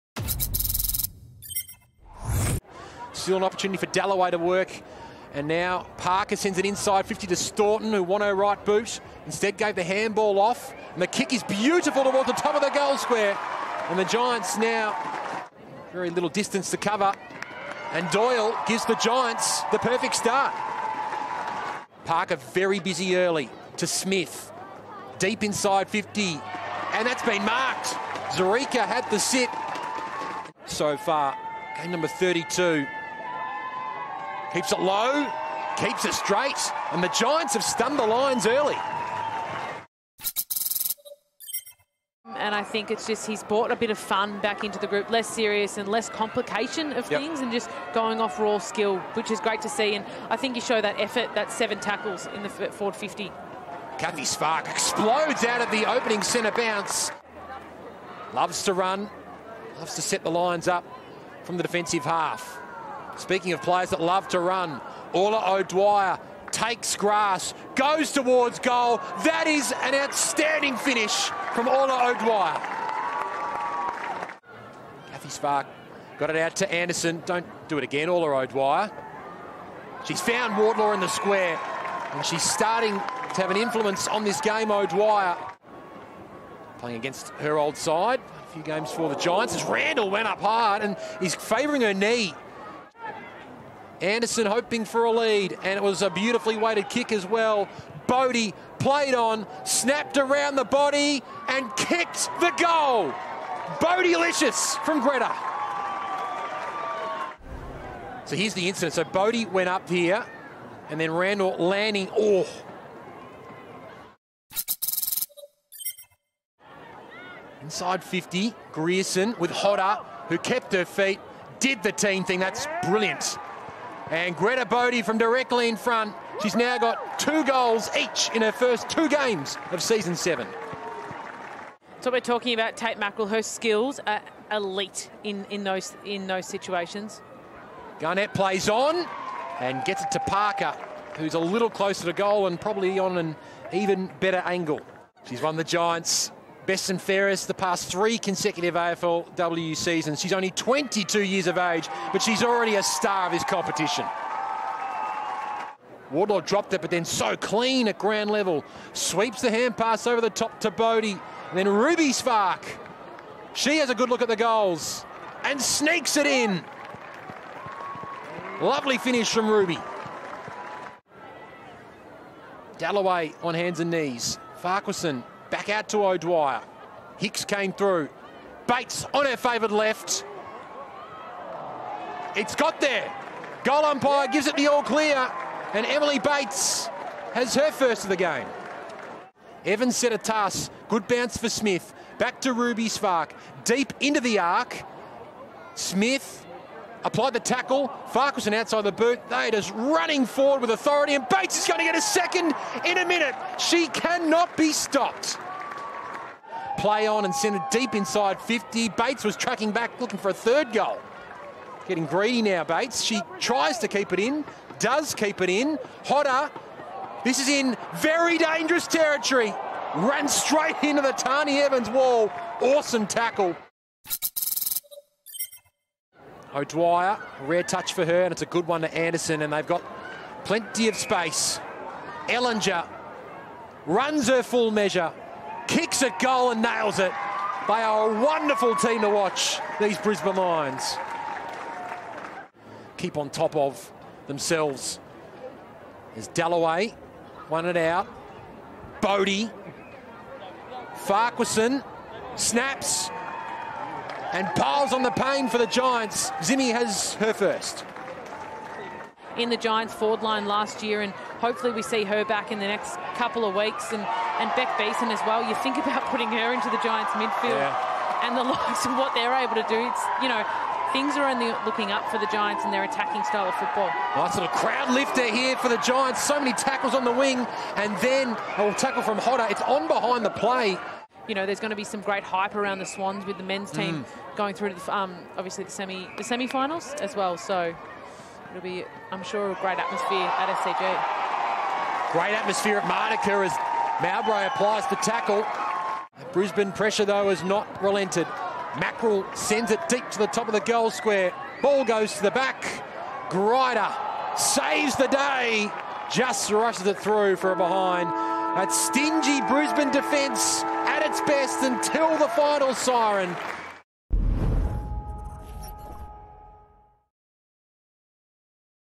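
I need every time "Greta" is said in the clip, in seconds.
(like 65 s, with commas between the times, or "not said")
105 s, 124 s.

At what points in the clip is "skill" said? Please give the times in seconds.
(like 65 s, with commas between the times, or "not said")
48 s, 133 s.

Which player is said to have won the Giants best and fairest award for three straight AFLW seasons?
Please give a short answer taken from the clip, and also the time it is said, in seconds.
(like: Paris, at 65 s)
Tait Mackrell, at 132 s.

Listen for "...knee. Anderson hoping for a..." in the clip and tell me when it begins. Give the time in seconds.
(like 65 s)
91 s.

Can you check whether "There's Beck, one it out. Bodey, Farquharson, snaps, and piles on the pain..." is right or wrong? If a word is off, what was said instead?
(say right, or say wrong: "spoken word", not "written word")
wrong: "Dalloway", not "Beck".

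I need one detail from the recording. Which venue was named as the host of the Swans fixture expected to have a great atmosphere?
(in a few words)
SCG.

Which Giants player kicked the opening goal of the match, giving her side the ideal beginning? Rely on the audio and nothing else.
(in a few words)
Doyle.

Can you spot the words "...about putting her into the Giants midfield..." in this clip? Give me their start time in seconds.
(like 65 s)
265 s.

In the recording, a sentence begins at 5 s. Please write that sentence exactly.
And now Parker sends it inside 50 to Staunton, who won her right boot.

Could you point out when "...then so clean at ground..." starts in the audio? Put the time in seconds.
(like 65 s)
156 s.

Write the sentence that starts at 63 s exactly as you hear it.
Speaking of players that love to run, Orla O'Dwyer takes grass, goes towards goal.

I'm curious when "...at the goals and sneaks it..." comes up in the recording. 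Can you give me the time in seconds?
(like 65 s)
164 s.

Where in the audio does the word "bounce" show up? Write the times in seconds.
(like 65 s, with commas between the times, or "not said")
56 s, 191 s.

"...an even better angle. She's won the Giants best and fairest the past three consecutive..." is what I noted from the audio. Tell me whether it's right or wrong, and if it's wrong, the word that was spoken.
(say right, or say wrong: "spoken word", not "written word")
right.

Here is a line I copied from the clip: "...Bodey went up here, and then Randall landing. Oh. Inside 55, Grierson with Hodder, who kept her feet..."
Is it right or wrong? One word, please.
wrong.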